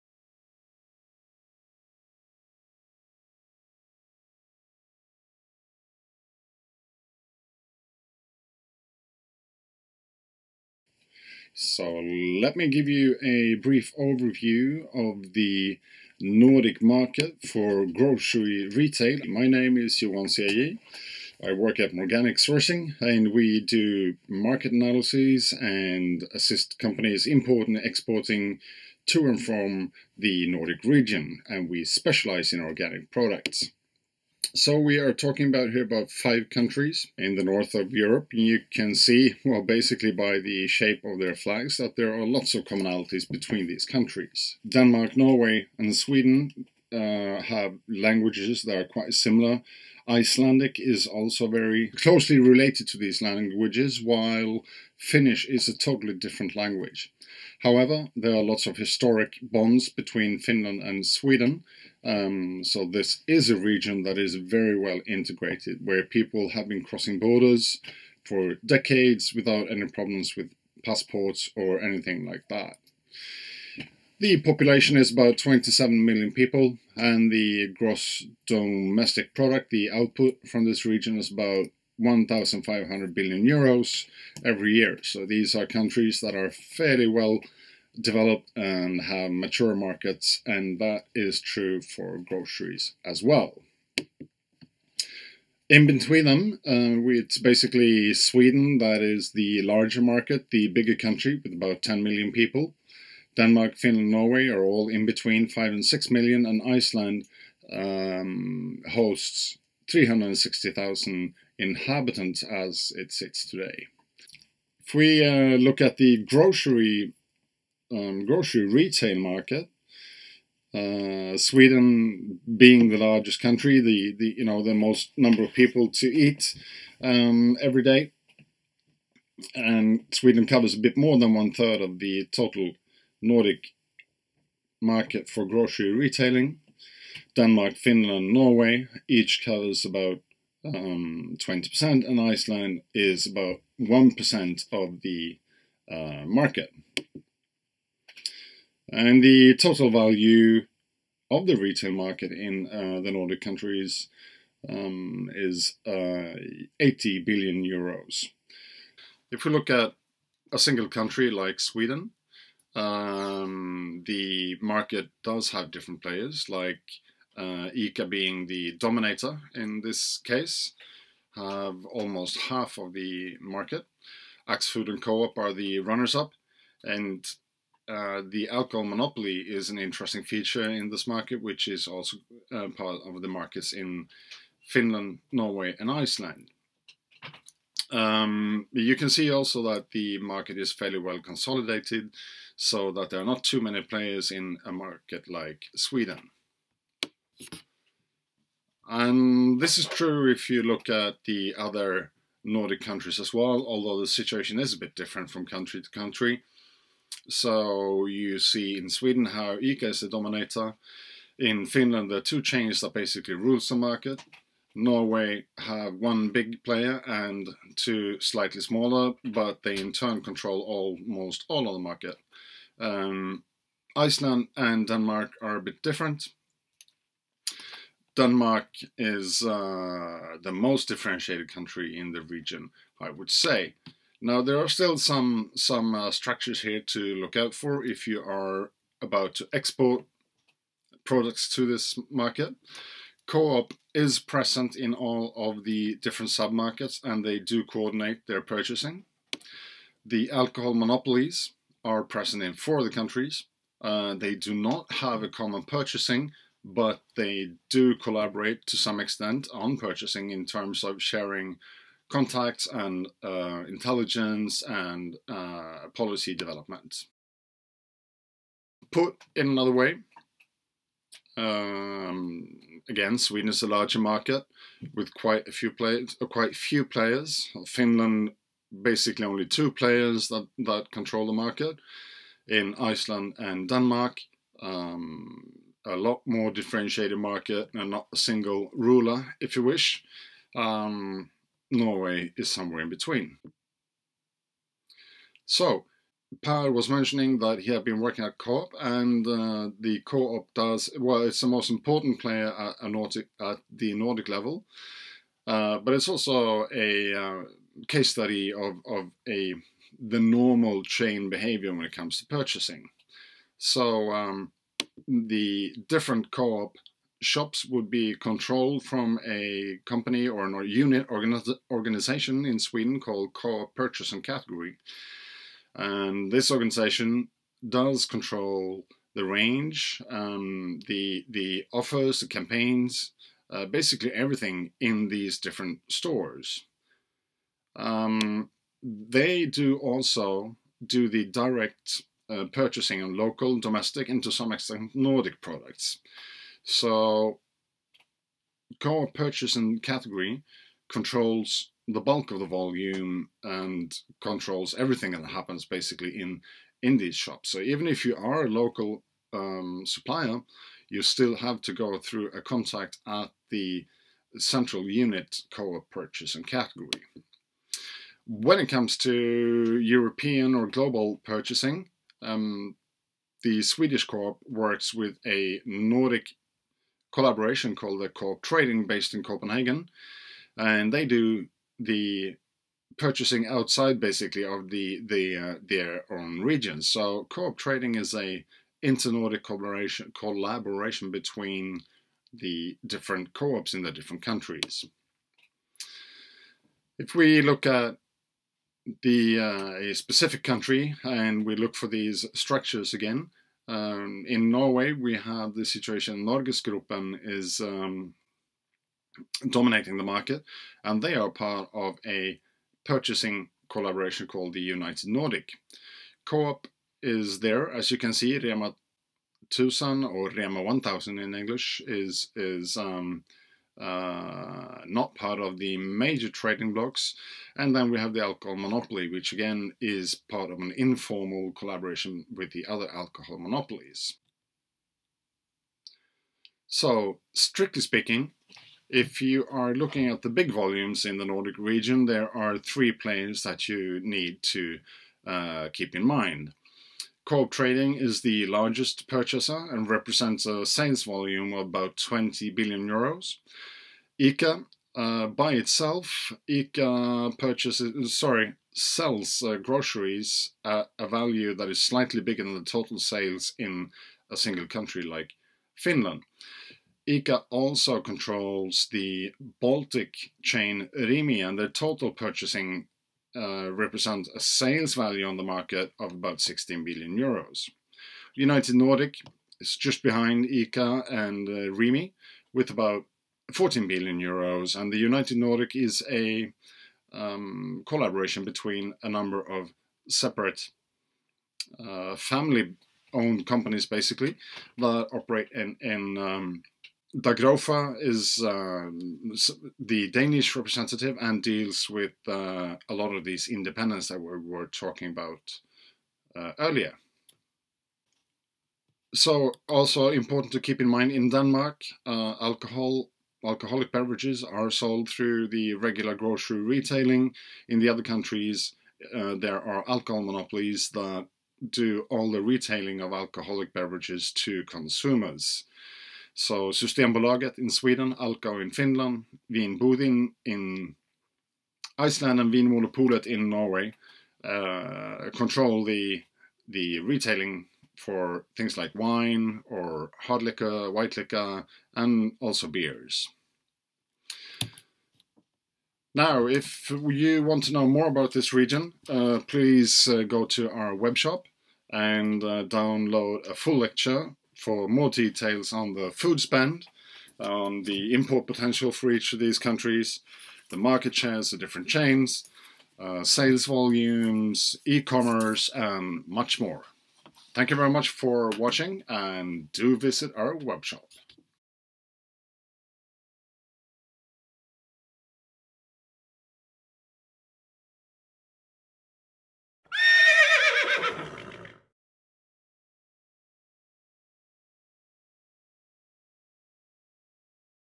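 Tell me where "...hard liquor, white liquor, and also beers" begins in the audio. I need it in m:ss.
9:00.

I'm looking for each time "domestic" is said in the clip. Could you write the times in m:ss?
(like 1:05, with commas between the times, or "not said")
1:18, 5:43.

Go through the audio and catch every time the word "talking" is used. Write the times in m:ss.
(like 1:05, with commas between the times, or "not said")
0:35, 8:24.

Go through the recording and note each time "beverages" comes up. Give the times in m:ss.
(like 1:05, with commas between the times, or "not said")
8:33, 8:43.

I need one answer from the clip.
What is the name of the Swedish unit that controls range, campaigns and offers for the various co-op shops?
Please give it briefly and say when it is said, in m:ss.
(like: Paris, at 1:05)
Co-op Purchase and Category, at 5:23.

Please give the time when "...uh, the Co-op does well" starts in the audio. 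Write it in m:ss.
4:59.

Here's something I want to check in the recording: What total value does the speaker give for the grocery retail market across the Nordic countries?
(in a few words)
80 billion euros.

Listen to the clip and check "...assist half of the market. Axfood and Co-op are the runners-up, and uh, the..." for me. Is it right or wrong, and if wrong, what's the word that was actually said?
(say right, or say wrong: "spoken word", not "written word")
wrong: "almost", not "assist".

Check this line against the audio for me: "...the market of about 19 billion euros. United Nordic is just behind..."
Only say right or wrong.
wrong.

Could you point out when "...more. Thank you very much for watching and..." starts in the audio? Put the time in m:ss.
9:26.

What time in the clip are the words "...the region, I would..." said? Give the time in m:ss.
3:52.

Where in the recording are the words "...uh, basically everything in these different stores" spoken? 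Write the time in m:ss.
5:33.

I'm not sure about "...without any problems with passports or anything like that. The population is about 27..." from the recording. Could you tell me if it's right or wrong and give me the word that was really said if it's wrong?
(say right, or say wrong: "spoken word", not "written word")
right.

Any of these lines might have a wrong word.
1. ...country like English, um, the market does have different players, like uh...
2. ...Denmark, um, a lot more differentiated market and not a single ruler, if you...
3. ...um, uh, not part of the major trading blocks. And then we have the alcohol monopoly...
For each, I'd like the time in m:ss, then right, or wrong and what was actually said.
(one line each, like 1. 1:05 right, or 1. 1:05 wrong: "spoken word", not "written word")
1. 2:40 wrong: "Sweden", not "English"
2. 4:43 right
3. 7:02 right.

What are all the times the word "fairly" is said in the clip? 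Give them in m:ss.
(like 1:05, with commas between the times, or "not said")
1:26, 3:10.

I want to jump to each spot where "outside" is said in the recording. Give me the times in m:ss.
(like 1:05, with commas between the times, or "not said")
6:23.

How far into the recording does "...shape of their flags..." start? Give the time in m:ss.
0:40.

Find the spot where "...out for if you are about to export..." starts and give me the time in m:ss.
3:57.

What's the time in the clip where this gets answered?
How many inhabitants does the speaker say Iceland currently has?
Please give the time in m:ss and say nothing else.
1:49.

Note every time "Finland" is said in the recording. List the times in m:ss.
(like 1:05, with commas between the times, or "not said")
1:00, 1:43, 2:17, 3:04, 3:31, 4:37, 7:45, 8:48.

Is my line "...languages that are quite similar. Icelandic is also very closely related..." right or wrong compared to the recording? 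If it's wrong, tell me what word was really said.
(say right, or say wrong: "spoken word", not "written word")
right.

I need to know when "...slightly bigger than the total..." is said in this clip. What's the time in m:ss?
7:41.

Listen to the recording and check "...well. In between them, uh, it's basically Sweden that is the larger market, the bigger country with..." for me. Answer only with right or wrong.
right.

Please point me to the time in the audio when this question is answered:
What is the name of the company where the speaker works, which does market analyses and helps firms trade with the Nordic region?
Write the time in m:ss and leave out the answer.
0:21.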